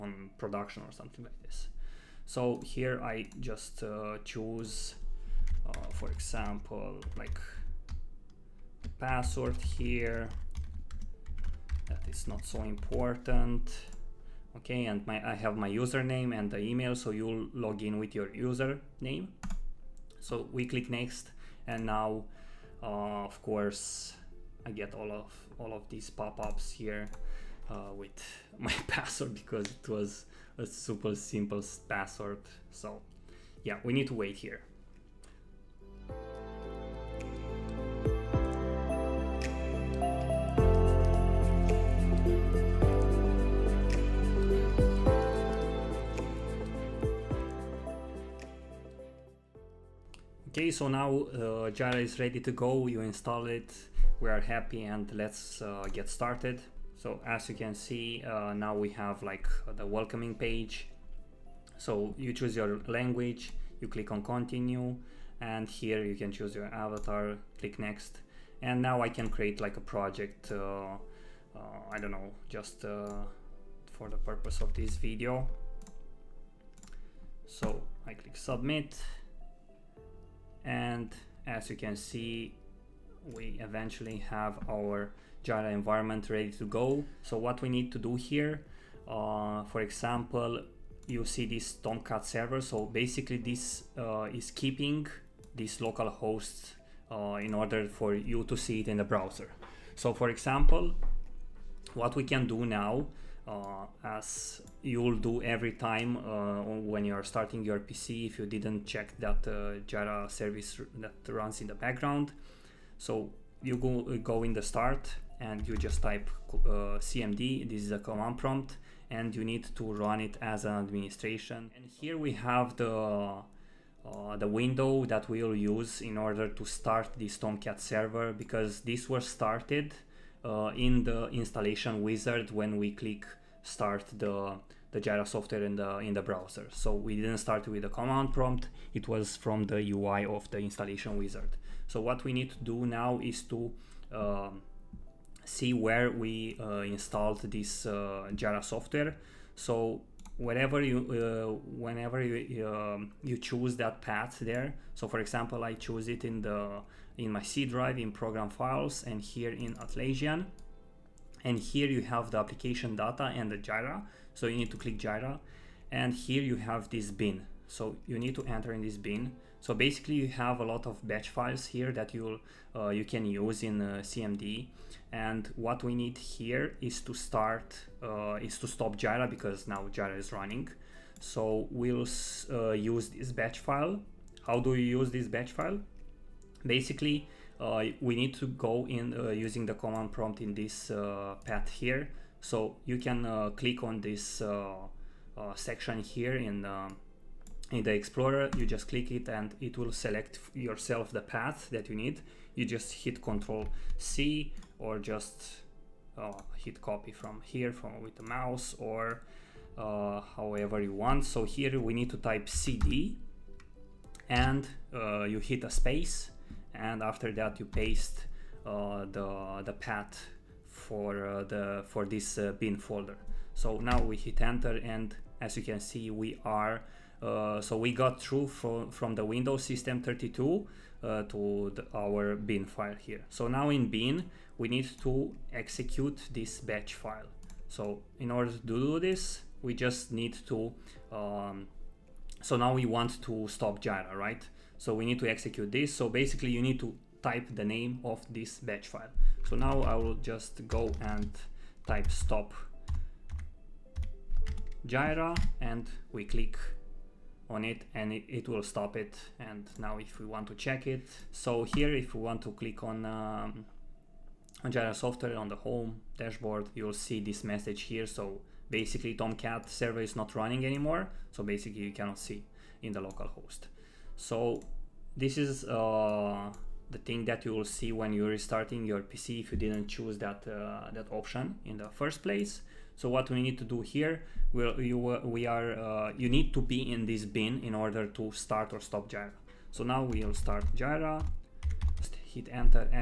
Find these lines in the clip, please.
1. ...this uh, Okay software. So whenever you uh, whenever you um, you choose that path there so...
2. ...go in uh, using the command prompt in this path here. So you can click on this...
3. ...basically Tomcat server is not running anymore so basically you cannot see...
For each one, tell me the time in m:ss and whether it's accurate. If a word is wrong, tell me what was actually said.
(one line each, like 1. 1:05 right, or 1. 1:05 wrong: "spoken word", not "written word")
1. 2:27 wrong: "Jira", not "Okay"
2. 3:08 right
3. 4:28 right.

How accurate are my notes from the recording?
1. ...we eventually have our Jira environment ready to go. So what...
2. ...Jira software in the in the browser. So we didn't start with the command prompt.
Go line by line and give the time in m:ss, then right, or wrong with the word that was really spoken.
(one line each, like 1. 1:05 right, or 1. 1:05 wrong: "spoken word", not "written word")
1. 1:23 right
2. 2:15 right.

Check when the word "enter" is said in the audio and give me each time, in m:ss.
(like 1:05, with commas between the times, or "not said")
2:48, 3:44, 4:52.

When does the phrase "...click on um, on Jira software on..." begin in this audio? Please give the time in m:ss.
4:22.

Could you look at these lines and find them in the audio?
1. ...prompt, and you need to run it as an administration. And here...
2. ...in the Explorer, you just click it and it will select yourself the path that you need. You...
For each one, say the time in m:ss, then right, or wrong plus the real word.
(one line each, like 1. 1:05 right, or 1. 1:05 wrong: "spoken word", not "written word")
1. 1:58 right
2. 3:17 right.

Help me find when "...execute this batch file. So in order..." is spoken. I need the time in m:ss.
3:55.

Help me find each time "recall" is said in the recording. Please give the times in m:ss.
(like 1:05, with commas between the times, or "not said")
not said.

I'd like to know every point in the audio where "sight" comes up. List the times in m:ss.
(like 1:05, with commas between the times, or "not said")
not said.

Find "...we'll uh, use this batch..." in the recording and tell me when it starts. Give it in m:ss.
3:01.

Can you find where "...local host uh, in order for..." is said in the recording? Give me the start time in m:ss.
1:35.